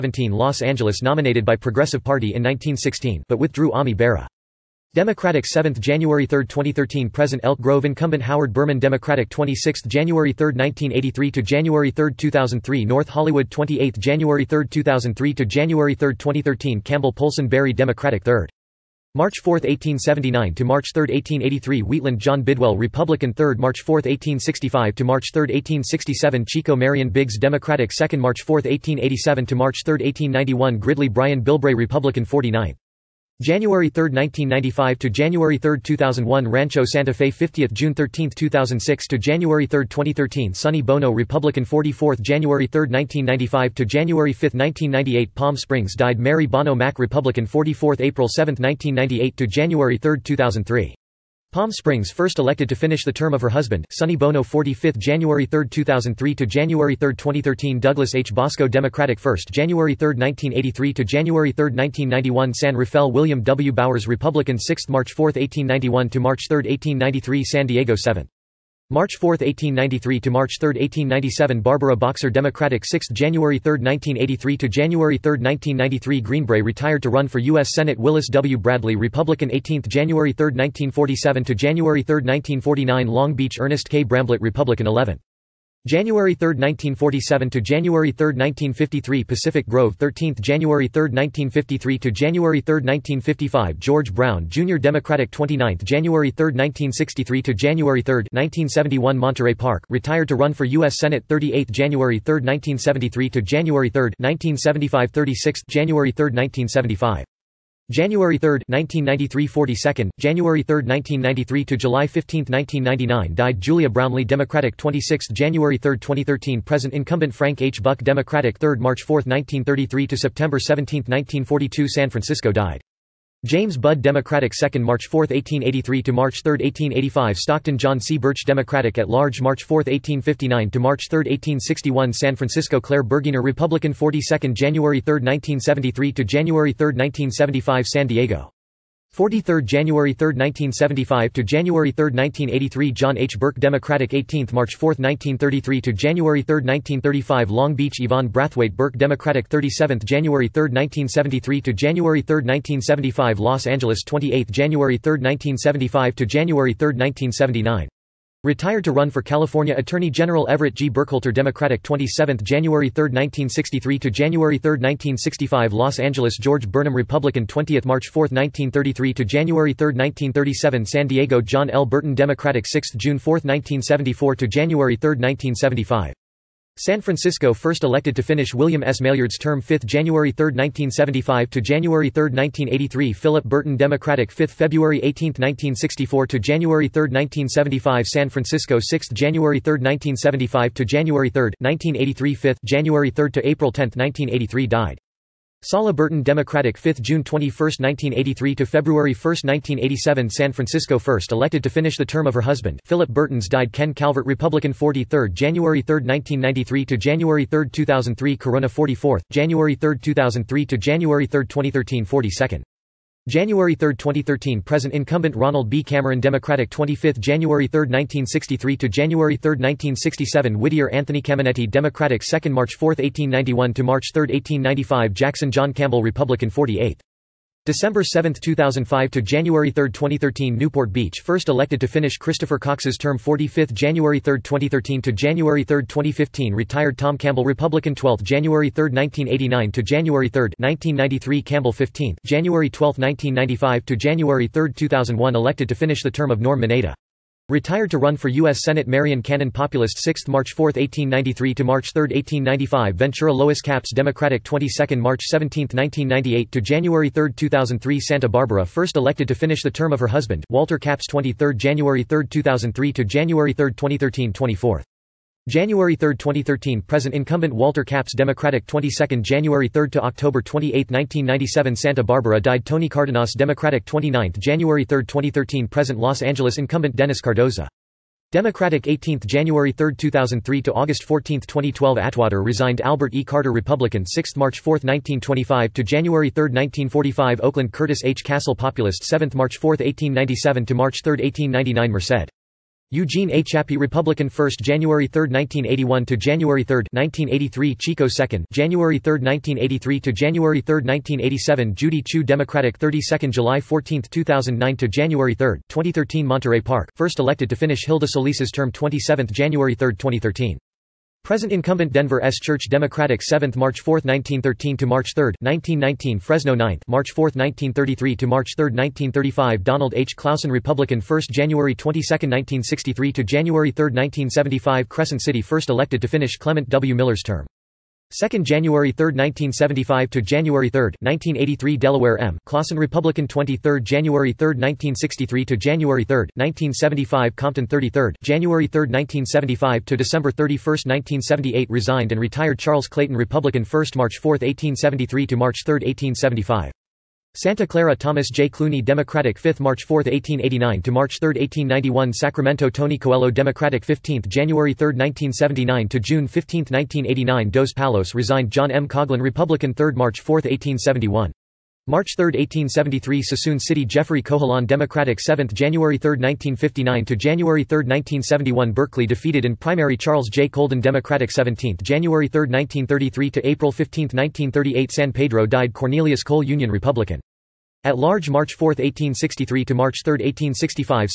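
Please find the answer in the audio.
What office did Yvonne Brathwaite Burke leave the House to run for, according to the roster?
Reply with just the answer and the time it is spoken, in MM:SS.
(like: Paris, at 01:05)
California Attorney General, at 02:39.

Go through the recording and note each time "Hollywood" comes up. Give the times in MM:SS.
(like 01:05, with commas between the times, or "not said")
00:13.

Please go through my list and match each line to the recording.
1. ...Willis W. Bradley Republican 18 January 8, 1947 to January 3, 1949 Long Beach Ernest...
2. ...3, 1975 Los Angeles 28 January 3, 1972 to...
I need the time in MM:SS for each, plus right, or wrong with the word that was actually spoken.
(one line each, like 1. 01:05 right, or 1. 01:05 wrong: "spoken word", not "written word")
1. 01:17 wrong: "3", not "8"
2. 02:32 wrong: "1975", not "1972".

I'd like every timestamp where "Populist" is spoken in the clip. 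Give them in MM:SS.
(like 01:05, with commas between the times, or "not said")
04:09, 04:48.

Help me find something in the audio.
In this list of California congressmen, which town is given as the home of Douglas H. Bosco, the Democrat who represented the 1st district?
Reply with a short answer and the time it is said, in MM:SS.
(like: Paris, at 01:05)
San Rafael, at 01:02.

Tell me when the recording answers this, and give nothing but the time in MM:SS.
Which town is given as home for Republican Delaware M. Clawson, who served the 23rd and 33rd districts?
05:37.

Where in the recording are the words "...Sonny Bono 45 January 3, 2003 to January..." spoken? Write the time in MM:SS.
00:53.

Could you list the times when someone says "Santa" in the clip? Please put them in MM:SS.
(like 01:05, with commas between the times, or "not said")
04:17, 04:31, 05:47.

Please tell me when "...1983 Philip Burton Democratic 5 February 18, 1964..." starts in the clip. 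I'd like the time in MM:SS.
03:02.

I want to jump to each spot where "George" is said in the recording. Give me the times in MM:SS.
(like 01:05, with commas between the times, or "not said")
01:33, 02:46.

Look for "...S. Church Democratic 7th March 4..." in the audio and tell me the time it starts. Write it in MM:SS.
05:12.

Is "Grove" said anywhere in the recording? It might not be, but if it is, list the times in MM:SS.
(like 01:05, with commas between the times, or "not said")
00:07, 01:29.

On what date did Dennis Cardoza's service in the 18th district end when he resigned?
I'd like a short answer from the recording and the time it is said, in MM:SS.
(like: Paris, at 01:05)
August 14, 2012, at 04:40.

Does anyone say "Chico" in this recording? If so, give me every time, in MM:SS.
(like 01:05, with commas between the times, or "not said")
00:26, 04:57.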